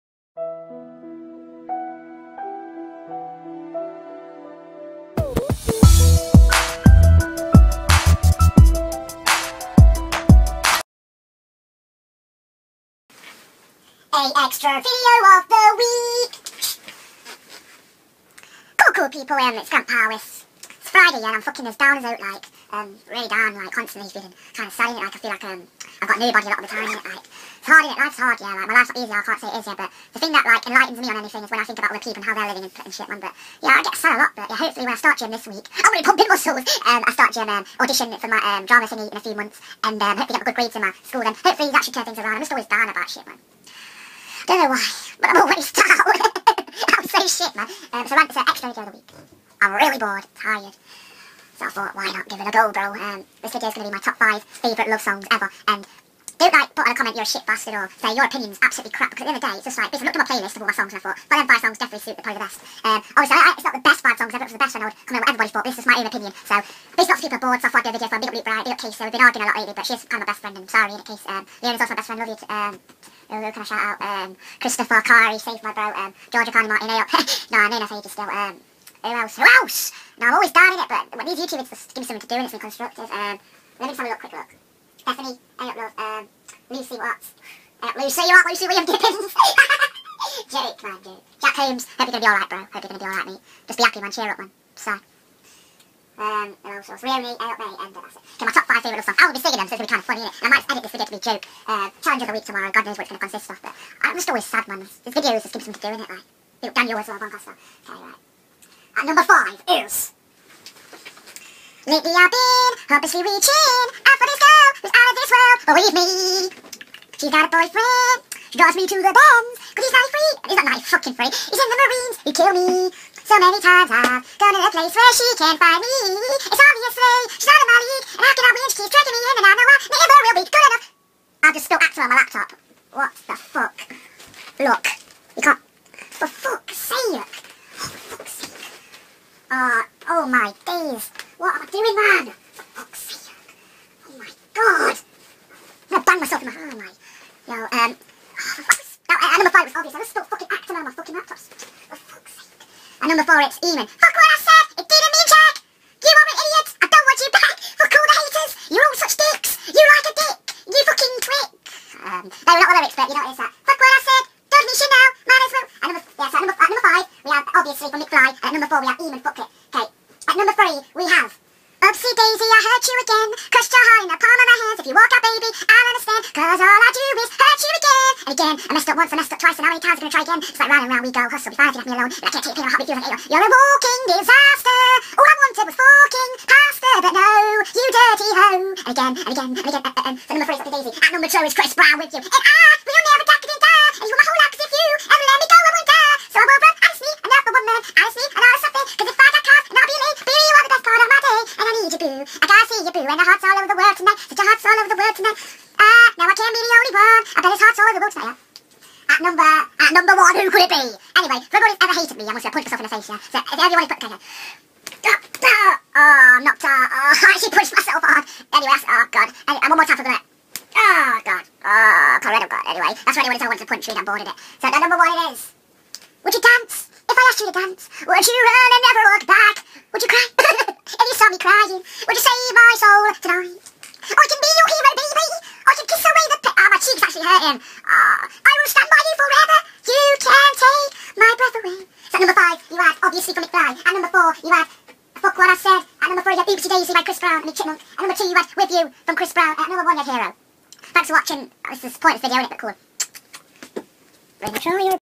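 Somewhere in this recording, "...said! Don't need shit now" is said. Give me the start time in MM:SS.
02:44.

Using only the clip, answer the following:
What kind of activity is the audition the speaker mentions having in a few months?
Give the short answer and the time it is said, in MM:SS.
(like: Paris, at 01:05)
drama, at 00:38.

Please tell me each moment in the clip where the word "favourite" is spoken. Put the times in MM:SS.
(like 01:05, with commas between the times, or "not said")
00:54, 01:38.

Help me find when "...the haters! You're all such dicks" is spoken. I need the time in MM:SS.
02:38.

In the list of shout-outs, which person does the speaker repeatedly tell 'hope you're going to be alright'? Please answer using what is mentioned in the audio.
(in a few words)
Jack Holmes.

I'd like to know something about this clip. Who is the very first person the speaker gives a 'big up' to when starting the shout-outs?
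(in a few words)
Luke Bright.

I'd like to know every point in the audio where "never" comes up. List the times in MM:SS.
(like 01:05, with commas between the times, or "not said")
03:13, 03:48.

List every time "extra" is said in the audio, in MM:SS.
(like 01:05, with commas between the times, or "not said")
00:14, 00:48.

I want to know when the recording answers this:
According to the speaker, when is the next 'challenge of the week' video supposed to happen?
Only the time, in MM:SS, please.
01:42.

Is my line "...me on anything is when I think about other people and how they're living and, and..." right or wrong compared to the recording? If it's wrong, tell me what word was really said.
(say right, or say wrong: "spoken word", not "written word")
right.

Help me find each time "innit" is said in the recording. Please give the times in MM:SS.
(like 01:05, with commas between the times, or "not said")
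01:40, 01:46.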